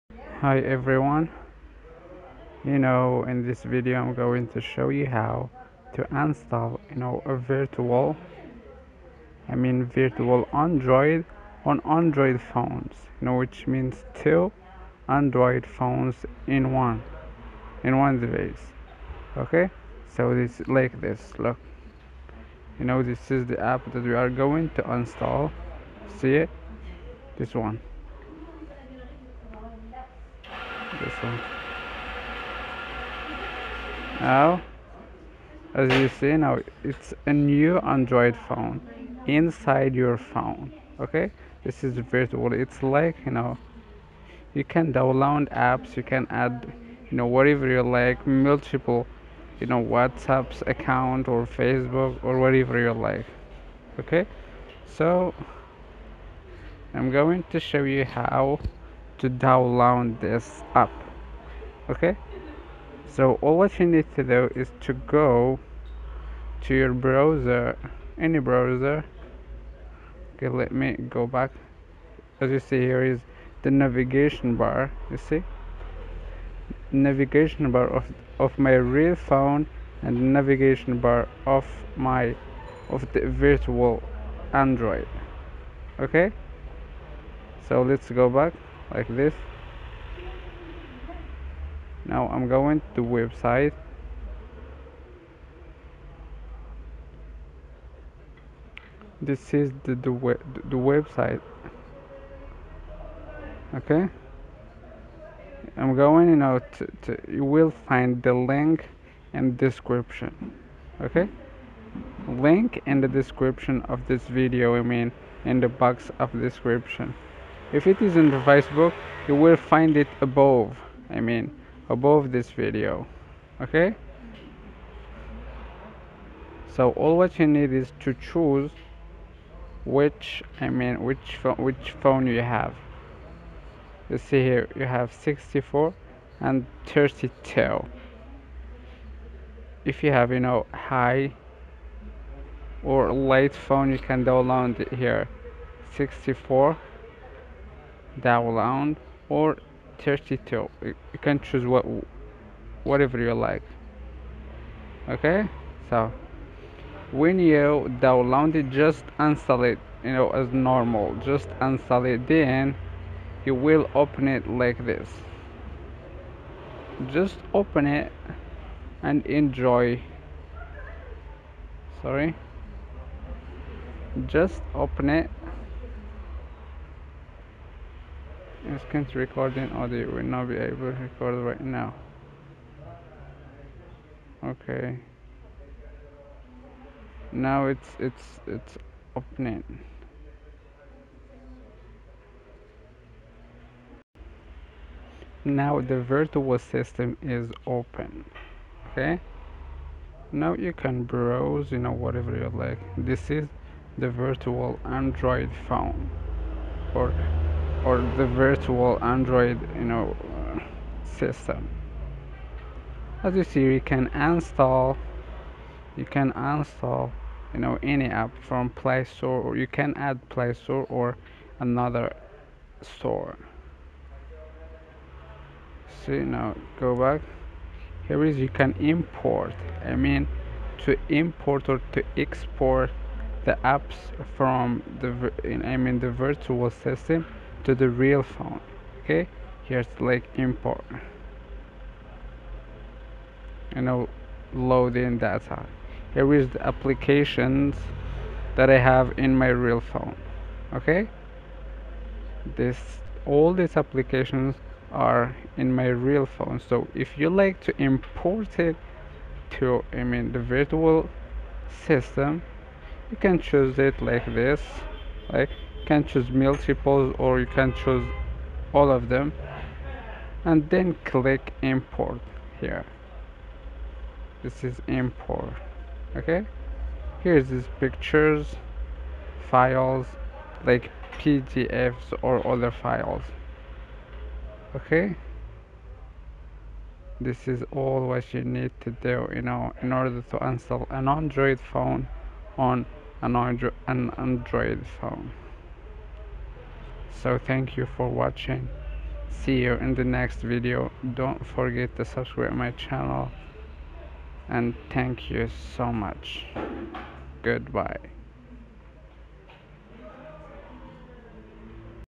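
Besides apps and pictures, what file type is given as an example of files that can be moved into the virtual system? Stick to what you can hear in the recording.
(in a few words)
PDFs.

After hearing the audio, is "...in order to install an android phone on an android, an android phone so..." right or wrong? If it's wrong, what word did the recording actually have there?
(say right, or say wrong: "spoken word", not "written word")
right.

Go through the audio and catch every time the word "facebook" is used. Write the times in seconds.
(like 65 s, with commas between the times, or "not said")
51 s, 118 s.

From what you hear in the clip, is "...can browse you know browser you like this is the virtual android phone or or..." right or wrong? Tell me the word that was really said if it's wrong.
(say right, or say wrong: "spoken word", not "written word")
wrong: "whatever", not "browser".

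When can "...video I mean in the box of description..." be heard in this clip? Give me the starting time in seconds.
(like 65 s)
114 s.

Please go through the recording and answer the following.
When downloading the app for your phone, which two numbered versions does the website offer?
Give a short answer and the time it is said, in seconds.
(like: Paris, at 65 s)
64 and 32, at 135 s.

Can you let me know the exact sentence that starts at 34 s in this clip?
Now, as you see now, it's a new Android phone inside your phone.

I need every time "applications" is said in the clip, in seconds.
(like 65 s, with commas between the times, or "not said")
246 s, 253 s.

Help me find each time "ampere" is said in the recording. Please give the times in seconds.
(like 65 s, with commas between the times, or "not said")
not said.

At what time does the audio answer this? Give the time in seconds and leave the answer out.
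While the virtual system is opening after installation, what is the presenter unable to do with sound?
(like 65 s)
179 s.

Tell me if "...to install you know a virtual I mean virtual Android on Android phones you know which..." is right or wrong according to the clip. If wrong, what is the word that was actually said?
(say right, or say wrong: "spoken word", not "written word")
right.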